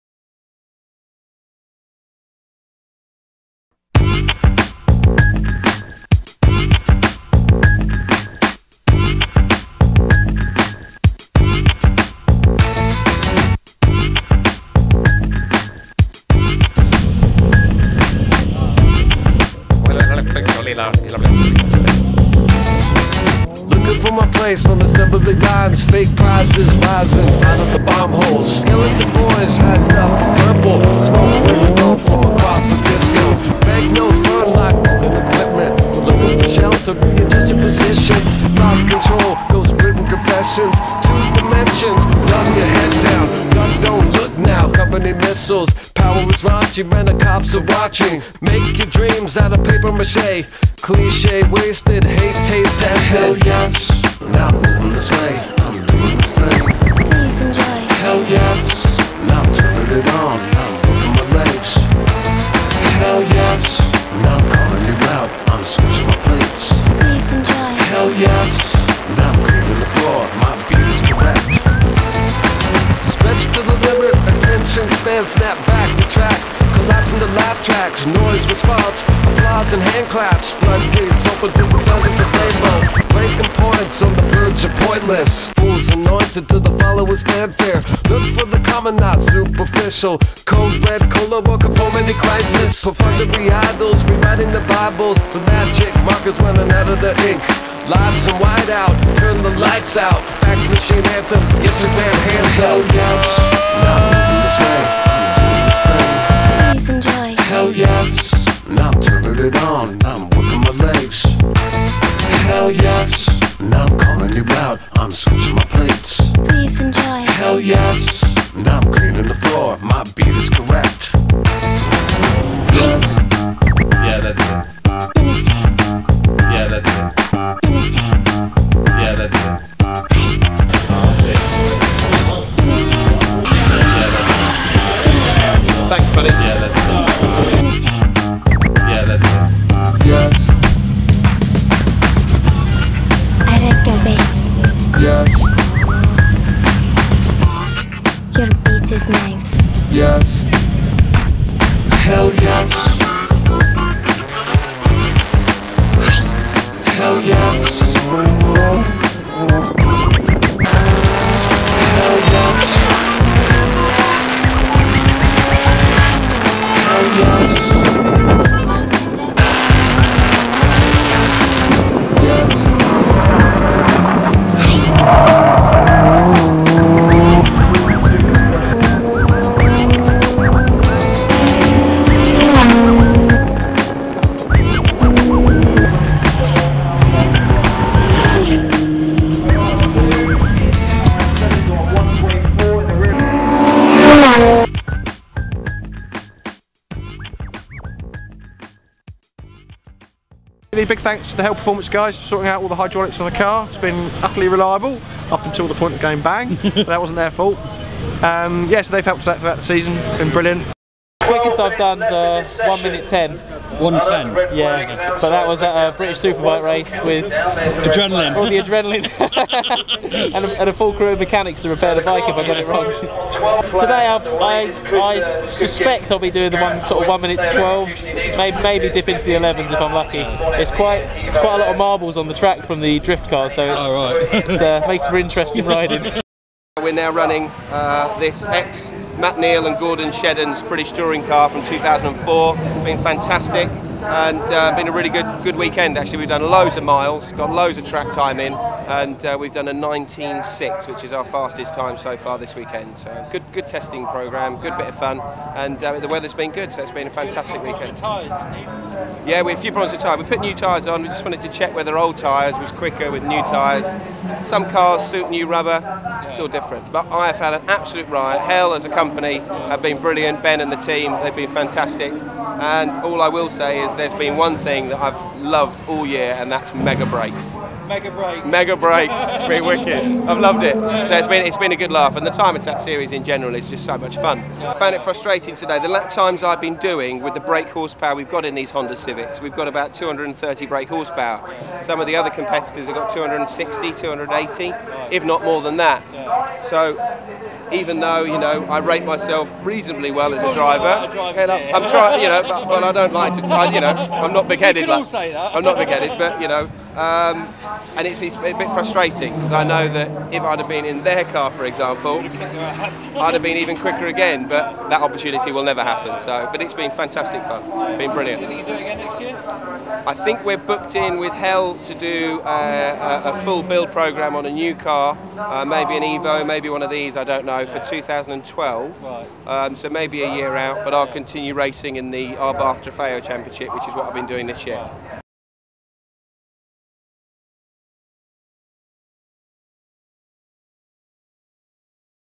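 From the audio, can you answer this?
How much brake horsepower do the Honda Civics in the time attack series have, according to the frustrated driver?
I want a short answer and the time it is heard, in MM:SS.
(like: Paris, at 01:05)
230, at 04:49.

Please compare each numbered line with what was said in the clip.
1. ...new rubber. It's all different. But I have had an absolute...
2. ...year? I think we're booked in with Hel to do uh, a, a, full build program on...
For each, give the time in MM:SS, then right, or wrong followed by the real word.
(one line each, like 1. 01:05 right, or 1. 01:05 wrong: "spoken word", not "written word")
1. 04:25 right
2. 05:19 right.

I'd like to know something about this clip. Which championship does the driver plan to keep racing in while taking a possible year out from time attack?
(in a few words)
Abarth Trofeo Championship.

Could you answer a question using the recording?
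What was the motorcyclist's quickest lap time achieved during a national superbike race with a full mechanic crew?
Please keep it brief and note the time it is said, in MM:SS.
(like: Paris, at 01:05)
1 minute 10, at 03:32.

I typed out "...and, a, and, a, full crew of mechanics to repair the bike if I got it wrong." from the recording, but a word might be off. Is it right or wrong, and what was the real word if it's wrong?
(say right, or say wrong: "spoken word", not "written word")
right.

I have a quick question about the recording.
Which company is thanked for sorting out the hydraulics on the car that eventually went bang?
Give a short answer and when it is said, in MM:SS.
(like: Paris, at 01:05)
Hel Performance, at 03:21.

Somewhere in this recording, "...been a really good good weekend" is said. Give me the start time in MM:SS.
04:04.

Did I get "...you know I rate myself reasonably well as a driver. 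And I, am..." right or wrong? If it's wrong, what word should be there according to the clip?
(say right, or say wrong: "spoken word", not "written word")
right.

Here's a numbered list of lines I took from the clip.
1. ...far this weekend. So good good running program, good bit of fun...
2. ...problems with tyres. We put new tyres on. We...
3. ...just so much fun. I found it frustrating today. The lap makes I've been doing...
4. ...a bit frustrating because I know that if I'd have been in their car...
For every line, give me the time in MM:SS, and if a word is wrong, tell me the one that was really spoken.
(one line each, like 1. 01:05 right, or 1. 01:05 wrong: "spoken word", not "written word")
1. 04:12 wrong: "testing", not "running"
2. 04:19 right
3. 04:43 wrong: "times", not "makes"
4. 05:08 right.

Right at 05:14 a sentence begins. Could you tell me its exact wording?
But that opportunity will never happen.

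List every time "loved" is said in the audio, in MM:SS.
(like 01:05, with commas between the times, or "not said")
04:35, 04:40.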